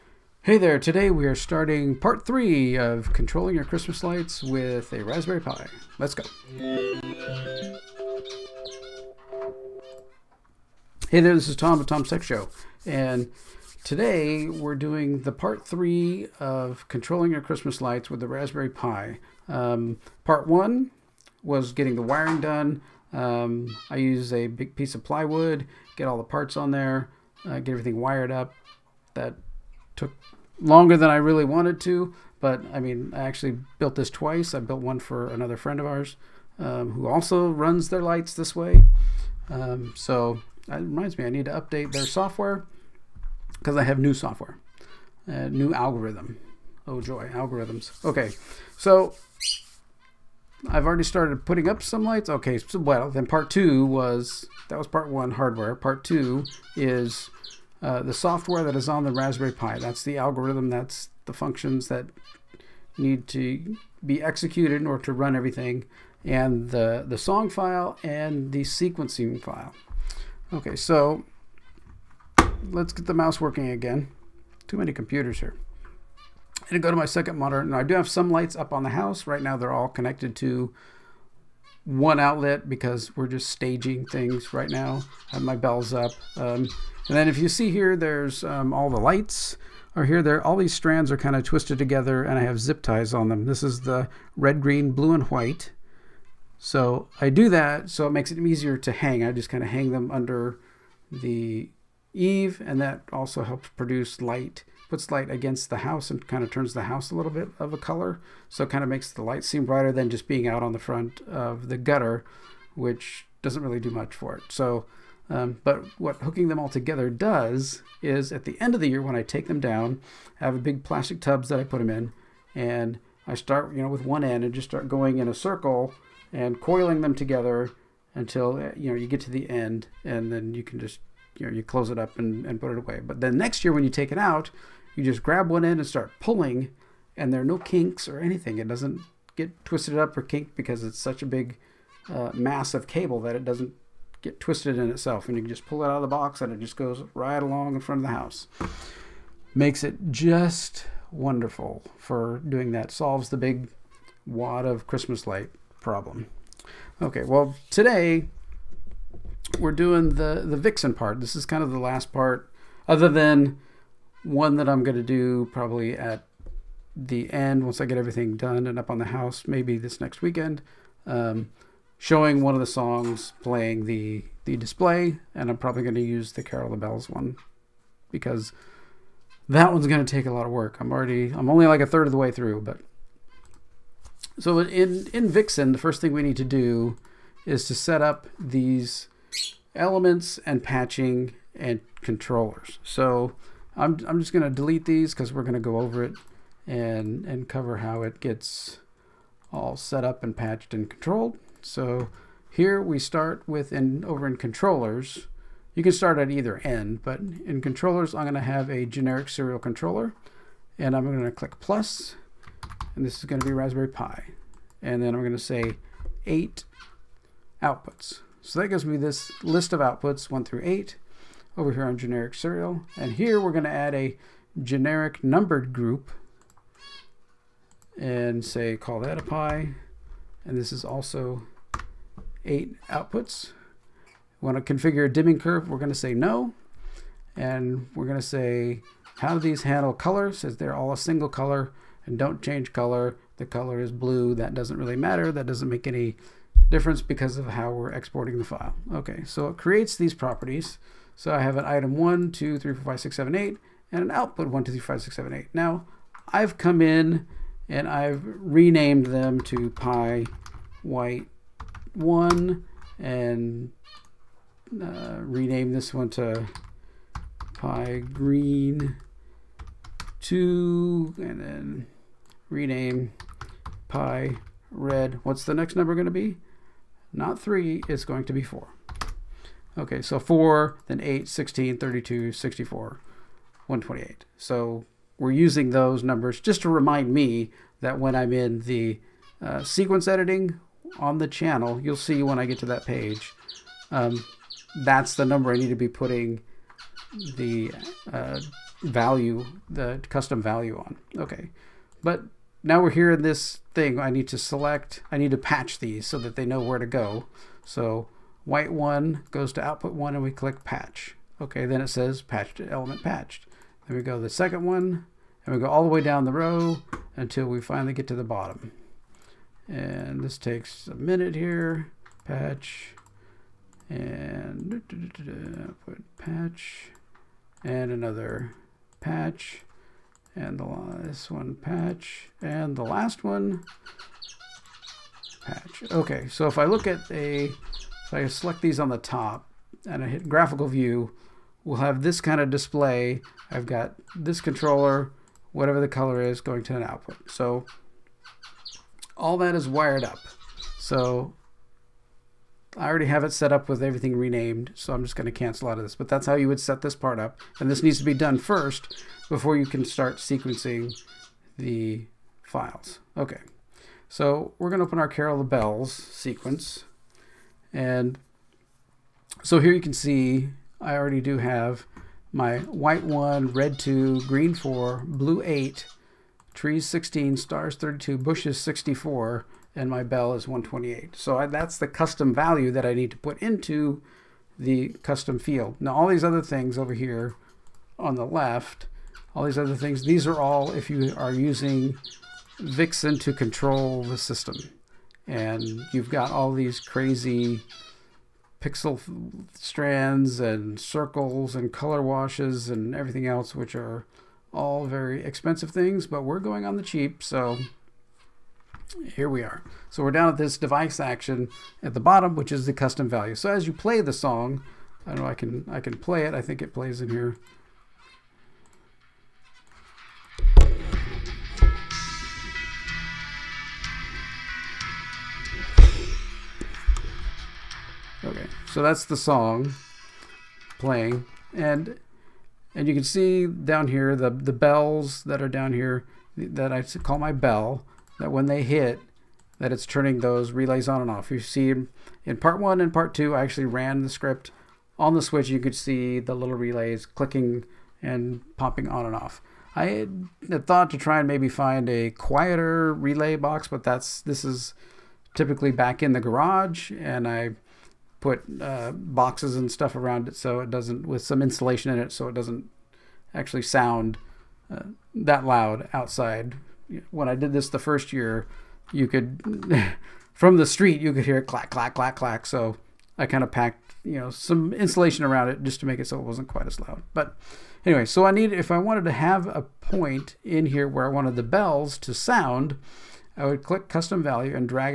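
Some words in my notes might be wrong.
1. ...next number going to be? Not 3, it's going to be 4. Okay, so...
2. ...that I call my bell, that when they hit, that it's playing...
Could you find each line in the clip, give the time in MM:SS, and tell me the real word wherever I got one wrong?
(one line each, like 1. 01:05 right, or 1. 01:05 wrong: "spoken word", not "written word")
1. 04:35 right
2. 07:16 wrong: "turning", not "playing".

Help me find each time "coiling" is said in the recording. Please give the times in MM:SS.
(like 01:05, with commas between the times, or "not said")
02:06.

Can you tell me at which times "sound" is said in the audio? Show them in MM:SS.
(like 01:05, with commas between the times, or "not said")
07:43, 08:02.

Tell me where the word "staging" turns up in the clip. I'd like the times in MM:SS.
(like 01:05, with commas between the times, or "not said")
01:23.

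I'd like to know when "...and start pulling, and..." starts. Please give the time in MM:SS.
02:15.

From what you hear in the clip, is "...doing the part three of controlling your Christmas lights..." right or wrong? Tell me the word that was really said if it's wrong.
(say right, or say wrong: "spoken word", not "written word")
right.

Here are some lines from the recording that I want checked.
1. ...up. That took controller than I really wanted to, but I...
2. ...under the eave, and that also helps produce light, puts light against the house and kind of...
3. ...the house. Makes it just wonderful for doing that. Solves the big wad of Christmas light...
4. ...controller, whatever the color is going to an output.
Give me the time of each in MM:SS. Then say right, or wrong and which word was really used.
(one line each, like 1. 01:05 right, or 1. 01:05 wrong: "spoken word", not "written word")
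1. 00:28 wrong: "longer", not "controller"
2. 01:40 right
3. 02:28 right
4. 05:44 right.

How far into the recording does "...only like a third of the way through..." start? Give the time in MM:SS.
03:01.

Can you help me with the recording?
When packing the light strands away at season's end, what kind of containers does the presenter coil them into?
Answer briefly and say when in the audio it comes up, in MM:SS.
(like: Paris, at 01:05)
Plastic tubs, at 02:00.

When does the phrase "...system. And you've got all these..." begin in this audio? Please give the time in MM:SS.
06:34.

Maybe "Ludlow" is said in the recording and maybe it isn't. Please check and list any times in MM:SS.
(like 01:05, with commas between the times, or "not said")
not said.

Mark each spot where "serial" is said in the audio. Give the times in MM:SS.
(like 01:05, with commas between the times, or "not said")
03:29, 03:42.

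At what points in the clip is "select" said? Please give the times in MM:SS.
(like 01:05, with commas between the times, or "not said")
05:04, 05:38.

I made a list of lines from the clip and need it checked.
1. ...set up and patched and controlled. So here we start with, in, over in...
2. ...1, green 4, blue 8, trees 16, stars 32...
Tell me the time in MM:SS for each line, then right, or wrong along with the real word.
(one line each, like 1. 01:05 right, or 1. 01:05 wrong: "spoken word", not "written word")
1. 03:19 right
2. 06:13 wrong: "2", not "1".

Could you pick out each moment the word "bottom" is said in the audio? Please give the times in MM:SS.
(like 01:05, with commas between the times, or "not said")
05:18, 06:51.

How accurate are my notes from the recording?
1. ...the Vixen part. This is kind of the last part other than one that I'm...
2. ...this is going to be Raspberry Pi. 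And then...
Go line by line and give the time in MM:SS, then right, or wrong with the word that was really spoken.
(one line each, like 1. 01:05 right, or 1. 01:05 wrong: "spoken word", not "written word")
1. 02:40 right
2. 03:33 right.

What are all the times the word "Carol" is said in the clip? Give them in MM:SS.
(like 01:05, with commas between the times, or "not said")
02:56, 06:05.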